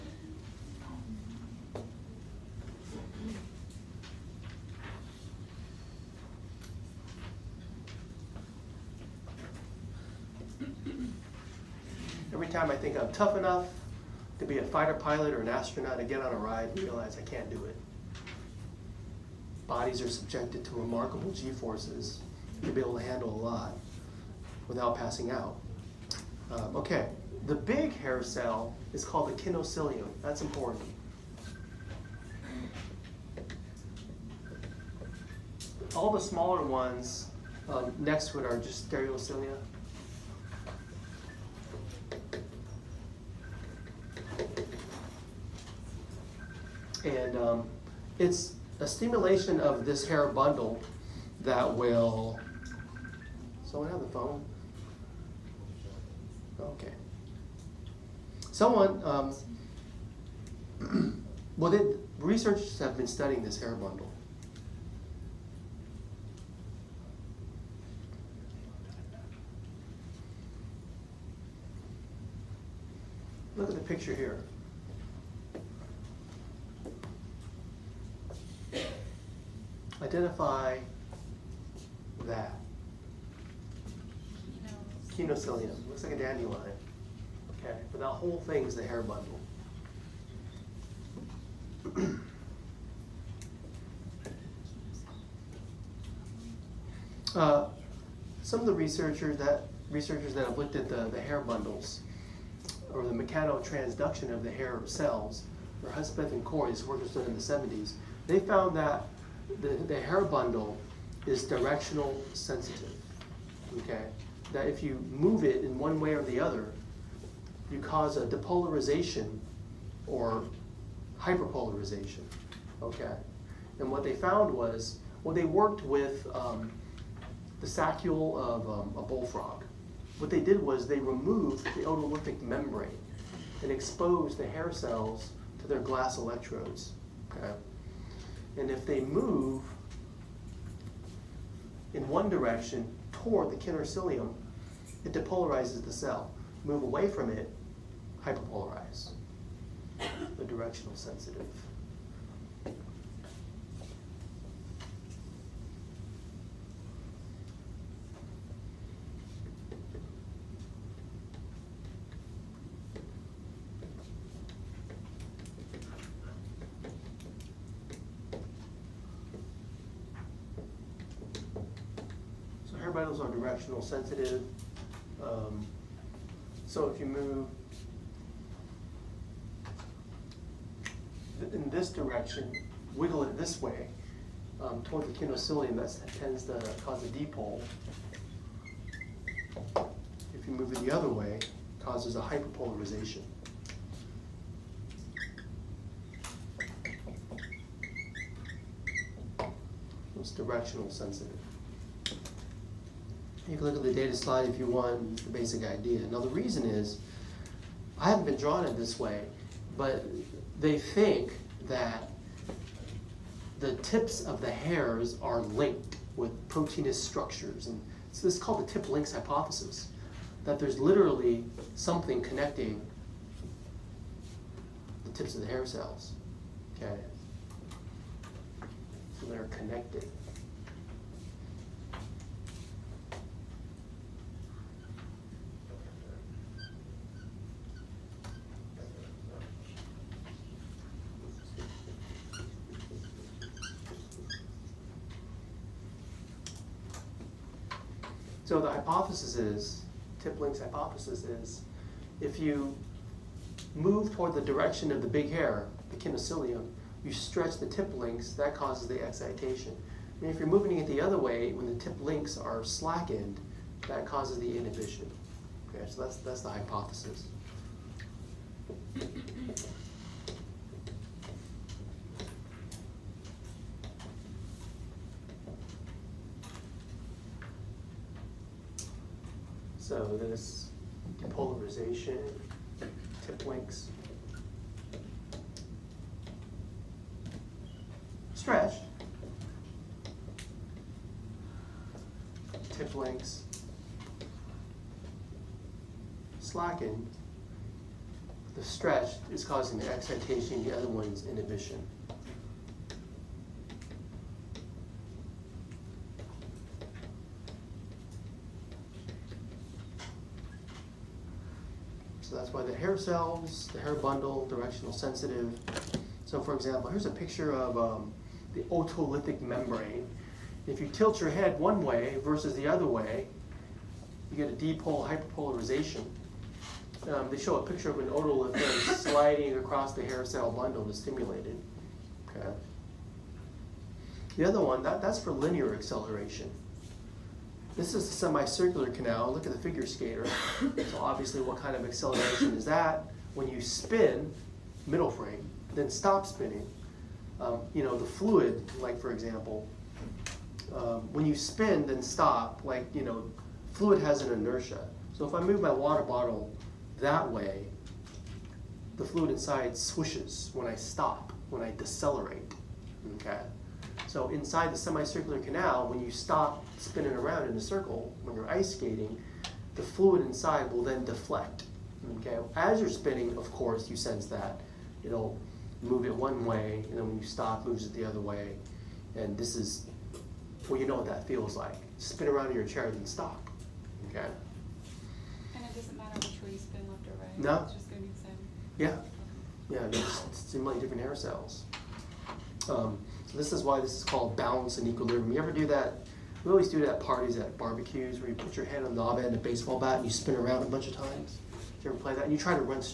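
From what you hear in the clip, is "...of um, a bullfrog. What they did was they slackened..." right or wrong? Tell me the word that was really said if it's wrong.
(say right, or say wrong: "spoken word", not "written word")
wrong: "removed", not "slackened".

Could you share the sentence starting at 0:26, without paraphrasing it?
Um, okay, the big hair cell is called the kinocilium.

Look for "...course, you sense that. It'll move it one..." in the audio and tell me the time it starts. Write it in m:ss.
6:13.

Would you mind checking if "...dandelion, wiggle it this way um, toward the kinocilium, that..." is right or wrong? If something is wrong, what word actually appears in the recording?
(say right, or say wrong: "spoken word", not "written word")
wrong: "direction", not "dandelion".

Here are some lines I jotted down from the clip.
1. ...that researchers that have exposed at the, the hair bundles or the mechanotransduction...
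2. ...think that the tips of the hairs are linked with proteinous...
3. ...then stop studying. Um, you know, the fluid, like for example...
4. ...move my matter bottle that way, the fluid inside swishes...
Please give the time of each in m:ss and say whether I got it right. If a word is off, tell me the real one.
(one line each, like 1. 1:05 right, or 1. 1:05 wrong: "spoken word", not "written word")
1. 1:39 wrong: "looked", not "exposed"
2. 3:30 right
3. 5:45 wrong: "spinning", not "studying"
4. 5:55 wrong: "water", not "matter".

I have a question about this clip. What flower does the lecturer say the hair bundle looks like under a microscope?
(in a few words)
dandelion.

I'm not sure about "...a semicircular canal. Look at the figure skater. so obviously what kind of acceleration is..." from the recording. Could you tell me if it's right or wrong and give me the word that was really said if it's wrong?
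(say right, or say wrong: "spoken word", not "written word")
right.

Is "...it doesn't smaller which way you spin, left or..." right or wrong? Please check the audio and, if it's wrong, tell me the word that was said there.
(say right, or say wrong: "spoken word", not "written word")
wrong: "matter", not "smaller".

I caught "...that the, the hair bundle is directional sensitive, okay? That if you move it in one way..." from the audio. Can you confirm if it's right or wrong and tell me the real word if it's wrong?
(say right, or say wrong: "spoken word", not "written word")
right.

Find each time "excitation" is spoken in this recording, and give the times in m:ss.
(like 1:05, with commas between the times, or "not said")
4:19, 4:59.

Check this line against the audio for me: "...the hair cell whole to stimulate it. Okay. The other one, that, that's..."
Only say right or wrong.
wrong.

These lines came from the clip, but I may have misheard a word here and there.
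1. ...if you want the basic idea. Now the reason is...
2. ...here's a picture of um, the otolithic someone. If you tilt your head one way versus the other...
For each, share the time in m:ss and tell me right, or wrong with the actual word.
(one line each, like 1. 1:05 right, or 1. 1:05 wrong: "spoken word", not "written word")
1. 3:24 right
2. 5:16 wrong: "membrane", not "someone".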